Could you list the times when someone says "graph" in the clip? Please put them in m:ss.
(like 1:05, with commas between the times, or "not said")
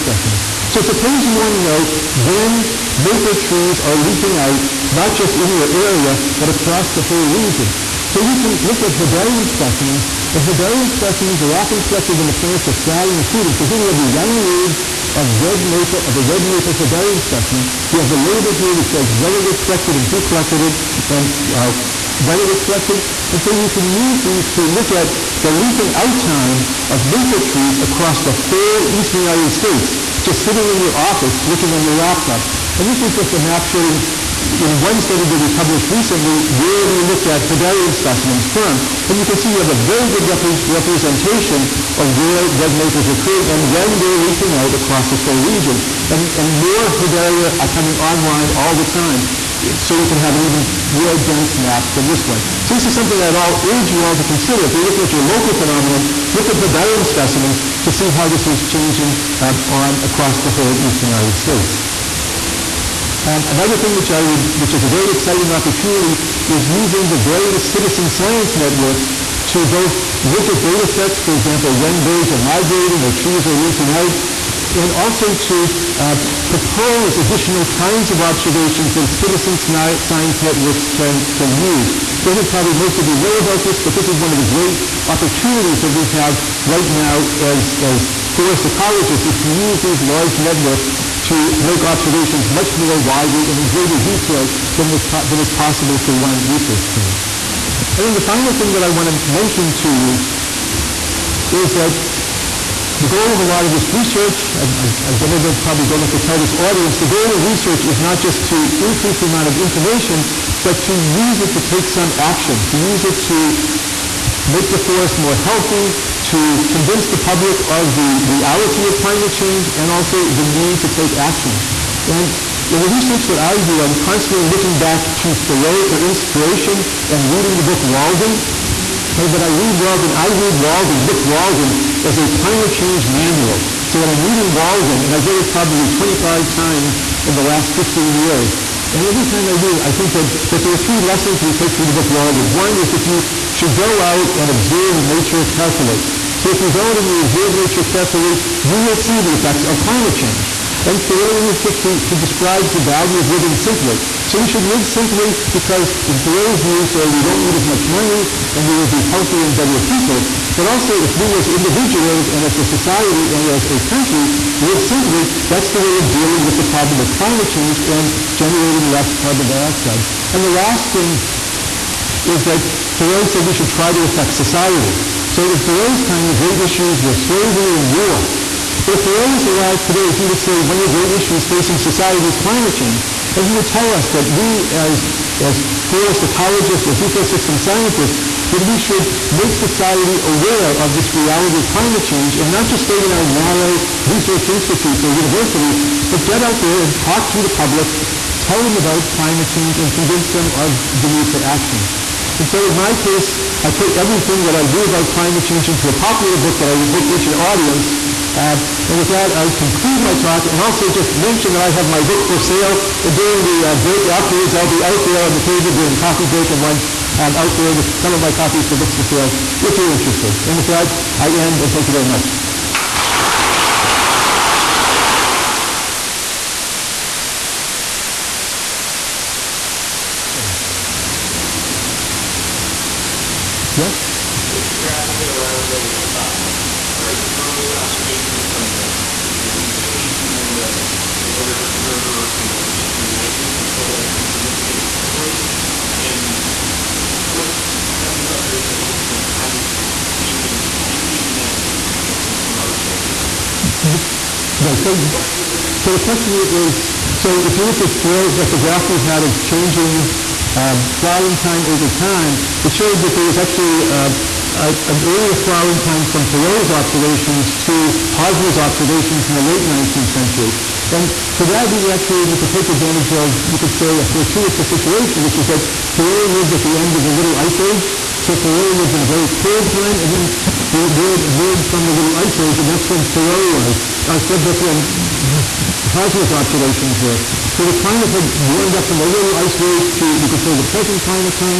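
3:54, 4:18.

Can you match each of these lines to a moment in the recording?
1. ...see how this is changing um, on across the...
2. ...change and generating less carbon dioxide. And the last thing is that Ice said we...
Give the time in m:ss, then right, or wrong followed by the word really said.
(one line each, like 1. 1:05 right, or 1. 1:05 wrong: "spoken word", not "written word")
1. 0:57 right
2. 2:47 wrong: "Thoreau", not "Ice".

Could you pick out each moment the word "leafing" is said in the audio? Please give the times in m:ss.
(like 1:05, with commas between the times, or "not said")
0:04, 0:25, 0:44, 1:13.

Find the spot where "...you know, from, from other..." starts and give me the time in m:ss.
4:11.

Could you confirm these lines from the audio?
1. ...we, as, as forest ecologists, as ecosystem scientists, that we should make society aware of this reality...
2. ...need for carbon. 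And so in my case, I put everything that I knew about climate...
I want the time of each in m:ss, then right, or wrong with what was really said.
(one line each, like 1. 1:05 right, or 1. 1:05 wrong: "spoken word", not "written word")
1. 3:04 right
2. 3:21 wrong: "action", not "carbon".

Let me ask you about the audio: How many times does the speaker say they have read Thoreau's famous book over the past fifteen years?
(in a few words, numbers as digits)
25.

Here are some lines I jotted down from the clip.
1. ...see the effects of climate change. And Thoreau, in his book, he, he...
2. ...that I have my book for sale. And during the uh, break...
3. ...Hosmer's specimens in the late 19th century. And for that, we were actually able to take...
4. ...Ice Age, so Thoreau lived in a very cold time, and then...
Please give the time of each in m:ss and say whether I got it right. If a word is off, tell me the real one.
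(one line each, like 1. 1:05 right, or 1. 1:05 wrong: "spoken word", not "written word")
1. 2:28 right
2. 3:31 right
3. 4:28 wrong: "observations", not "specimens"
4. 4:37 right.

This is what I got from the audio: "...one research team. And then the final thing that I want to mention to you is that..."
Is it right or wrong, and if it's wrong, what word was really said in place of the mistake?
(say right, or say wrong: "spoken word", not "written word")
right.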